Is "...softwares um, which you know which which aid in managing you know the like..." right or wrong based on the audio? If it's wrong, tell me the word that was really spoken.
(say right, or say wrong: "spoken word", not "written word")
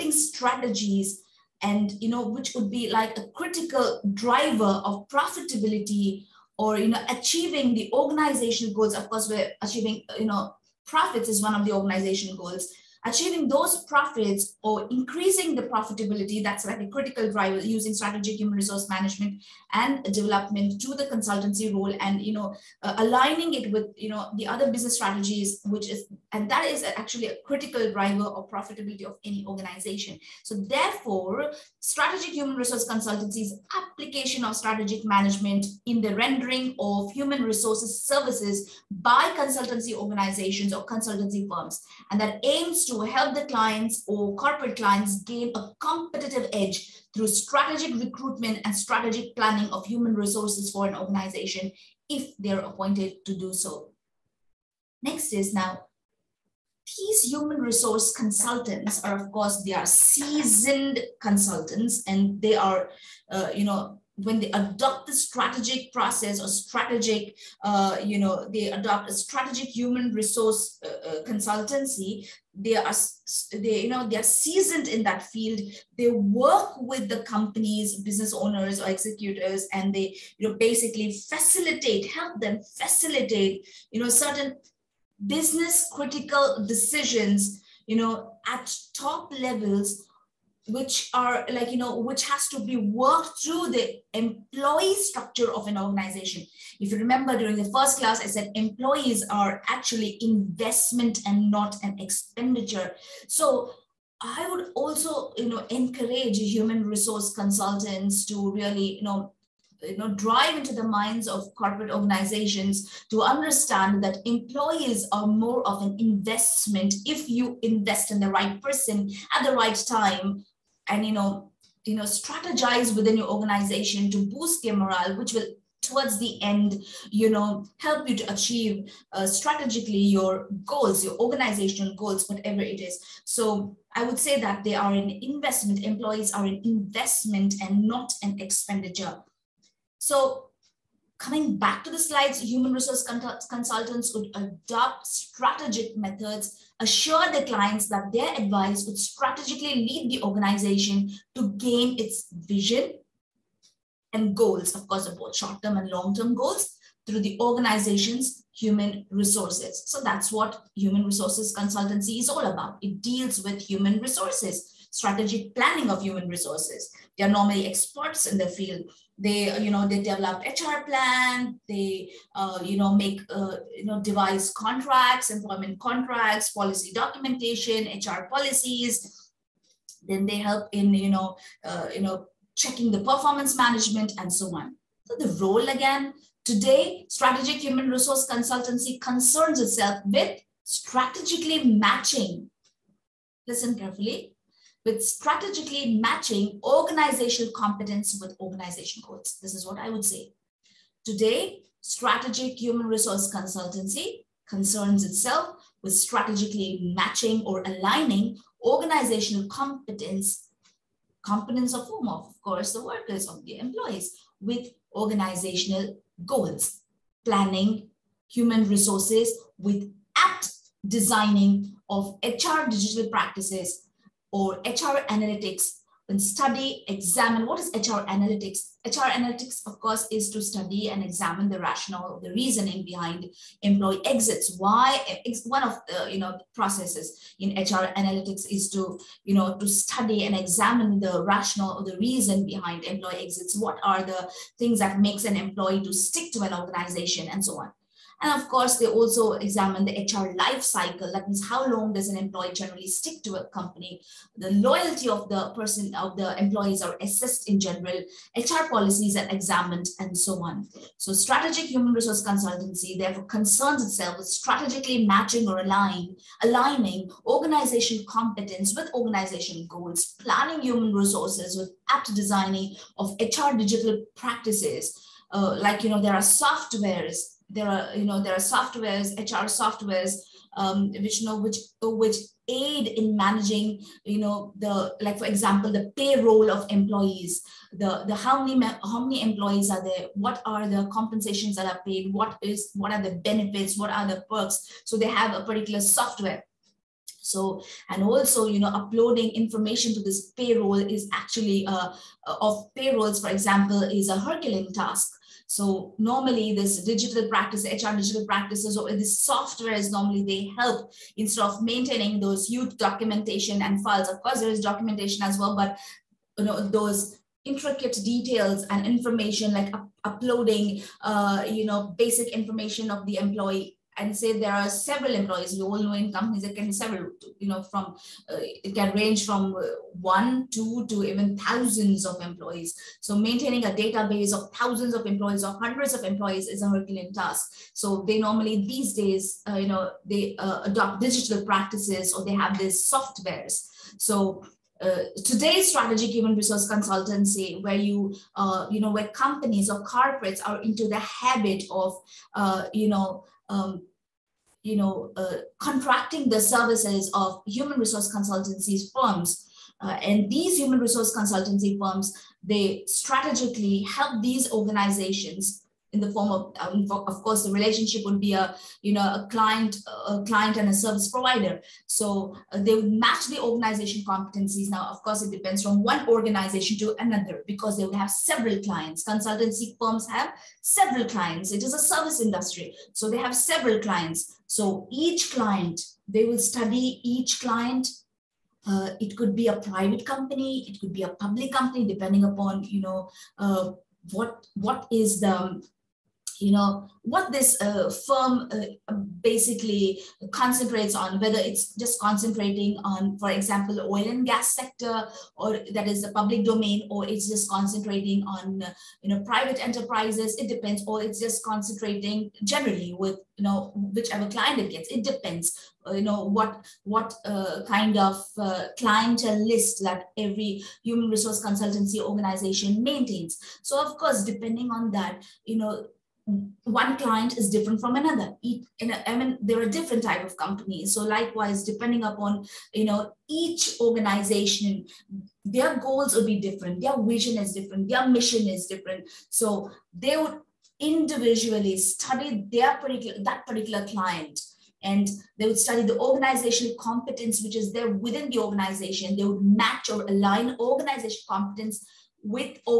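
right.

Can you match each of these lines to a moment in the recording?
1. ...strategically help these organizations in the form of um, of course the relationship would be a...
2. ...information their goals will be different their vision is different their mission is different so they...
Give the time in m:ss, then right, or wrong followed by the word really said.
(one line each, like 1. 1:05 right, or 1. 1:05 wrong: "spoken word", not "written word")
1. 6:02 right
2. 7:13 wrong: "organization", not "information".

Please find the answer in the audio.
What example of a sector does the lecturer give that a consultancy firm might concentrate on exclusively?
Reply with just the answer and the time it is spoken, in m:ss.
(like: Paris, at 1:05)
oil and gas, at 6:43.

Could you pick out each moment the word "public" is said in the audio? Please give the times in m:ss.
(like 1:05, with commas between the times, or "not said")
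6:31, 6:46.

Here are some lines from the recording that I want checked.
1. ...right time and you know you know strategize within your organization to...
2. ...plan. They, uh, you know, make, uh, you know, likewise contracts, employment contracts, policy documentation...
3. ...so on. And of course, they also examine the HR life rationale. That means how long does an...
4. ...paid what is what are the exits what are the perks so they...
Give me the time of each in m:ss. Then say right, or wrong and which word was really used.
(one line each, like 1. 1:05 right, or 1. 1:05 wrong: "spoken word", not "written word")
1. 1:59 right
2. 2:50 wrong: "devise", not "likewise"
3. 4:07 wrong: "cycle", not "rationale"
4. 4:51 wrong: "benefits", not "exits".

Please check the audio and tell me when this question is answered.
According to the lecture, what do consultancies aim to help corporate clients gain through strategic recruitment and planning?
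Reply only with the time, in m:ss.
0:45.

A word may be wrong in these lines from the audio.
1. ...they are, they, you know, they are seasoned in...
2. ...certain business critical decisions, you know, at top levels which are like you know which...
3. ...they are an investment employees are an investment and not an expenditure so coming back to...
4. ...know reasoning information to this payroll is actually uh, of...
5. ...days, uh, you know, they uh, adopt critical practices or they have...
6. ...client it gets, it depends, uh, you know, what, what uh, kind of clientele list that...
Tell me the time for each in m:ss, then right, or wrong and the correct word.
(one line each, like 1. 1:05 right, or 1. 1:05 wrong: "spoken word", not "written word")
1. 1:12 right
2. 1:24 right
3. 2:14 right
4. 4:58 wrong: "uploading", not "reasoning"
5. 5:38 wrong: "digital", not "critical"
6. 6:54 right.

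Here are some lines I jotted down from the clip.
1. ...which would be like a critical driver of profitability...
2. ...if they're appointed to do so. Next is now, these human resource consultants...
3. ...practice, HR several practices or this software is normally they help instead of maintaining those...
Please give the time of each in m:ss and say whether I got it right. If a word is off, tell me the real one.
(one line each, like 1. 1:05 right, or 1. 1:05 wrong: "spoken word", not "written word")
1. 0:02 right
2. 0:52 right
3. 5:07 wrong: "digital", not "several".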